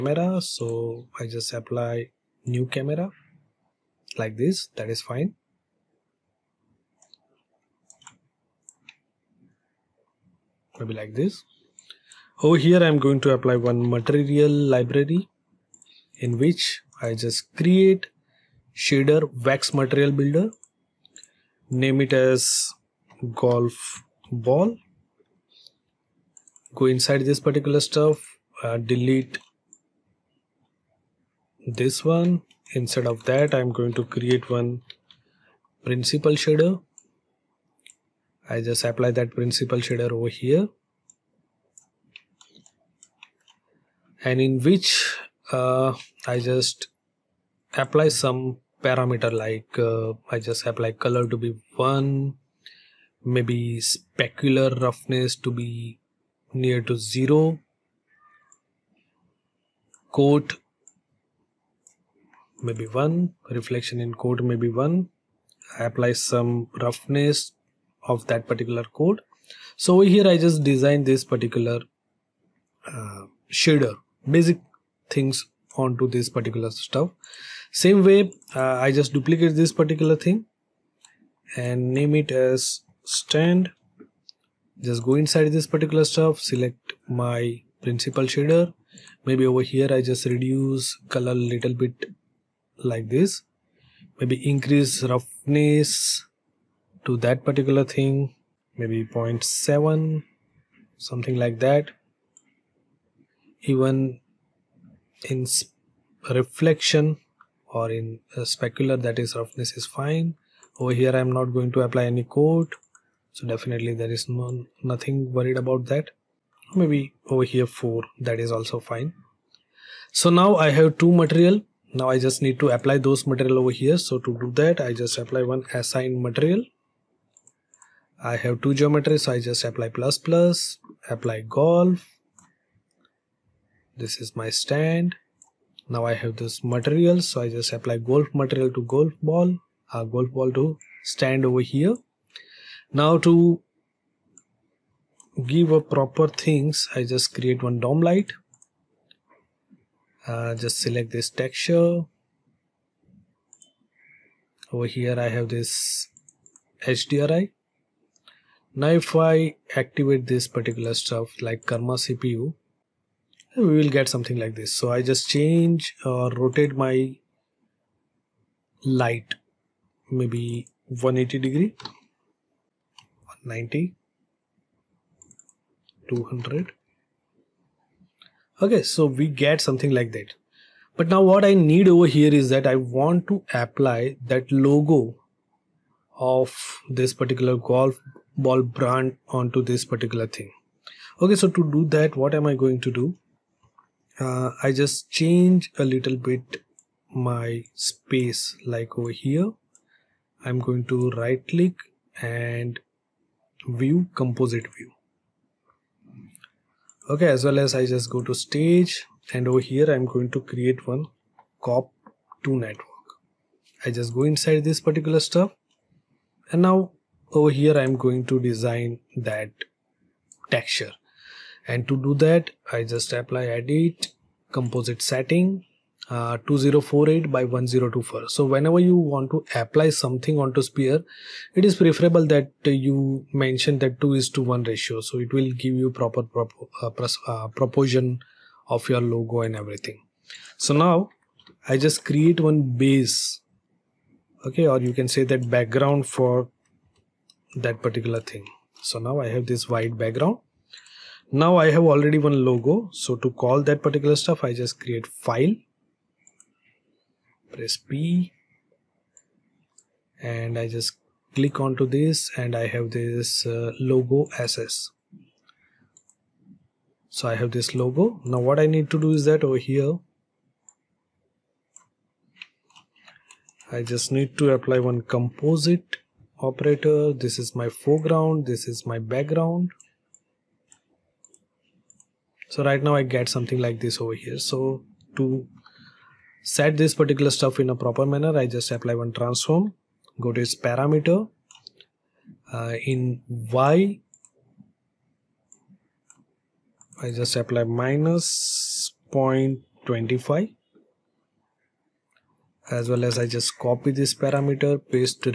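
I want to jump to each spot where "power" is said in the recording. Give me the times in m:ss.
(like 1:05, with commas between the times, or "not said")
not said.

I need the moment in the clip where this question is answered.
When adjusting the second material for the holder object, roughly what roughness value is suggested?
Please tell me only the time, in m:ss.
1:39.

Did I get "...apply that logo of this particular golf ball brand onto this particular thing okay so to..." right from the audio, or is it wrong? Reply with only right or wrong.
right.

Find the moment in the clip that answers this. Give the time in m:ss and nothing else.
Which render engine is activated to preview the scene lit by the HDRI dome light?
2:41.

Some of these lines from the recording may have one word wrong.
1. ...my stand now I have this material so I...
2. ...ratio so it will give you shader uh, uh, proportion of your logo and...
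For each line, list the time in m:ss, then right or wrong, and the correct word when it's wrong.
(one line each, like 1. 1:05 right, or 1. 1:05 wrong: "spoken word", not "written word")
1. 2:14 right
2. 3:54 wrong: "proper", not "shader".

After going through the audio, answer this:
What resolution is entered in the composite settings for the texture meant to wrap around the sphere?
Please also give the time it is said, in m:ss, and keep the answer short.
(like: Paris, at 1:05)
2048 by 1024, at 3:46.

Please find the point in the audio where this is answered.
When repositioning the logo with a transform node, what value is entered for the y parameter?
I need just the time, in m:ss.
4:57.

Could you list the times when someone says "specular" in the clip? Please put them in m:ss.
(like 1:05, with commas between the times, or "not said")
0:53, 1:48.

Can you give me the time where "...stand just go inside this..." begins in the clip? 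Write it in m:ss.
1:23.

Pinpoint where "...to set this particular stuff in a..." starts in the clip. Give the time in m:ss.
4:45.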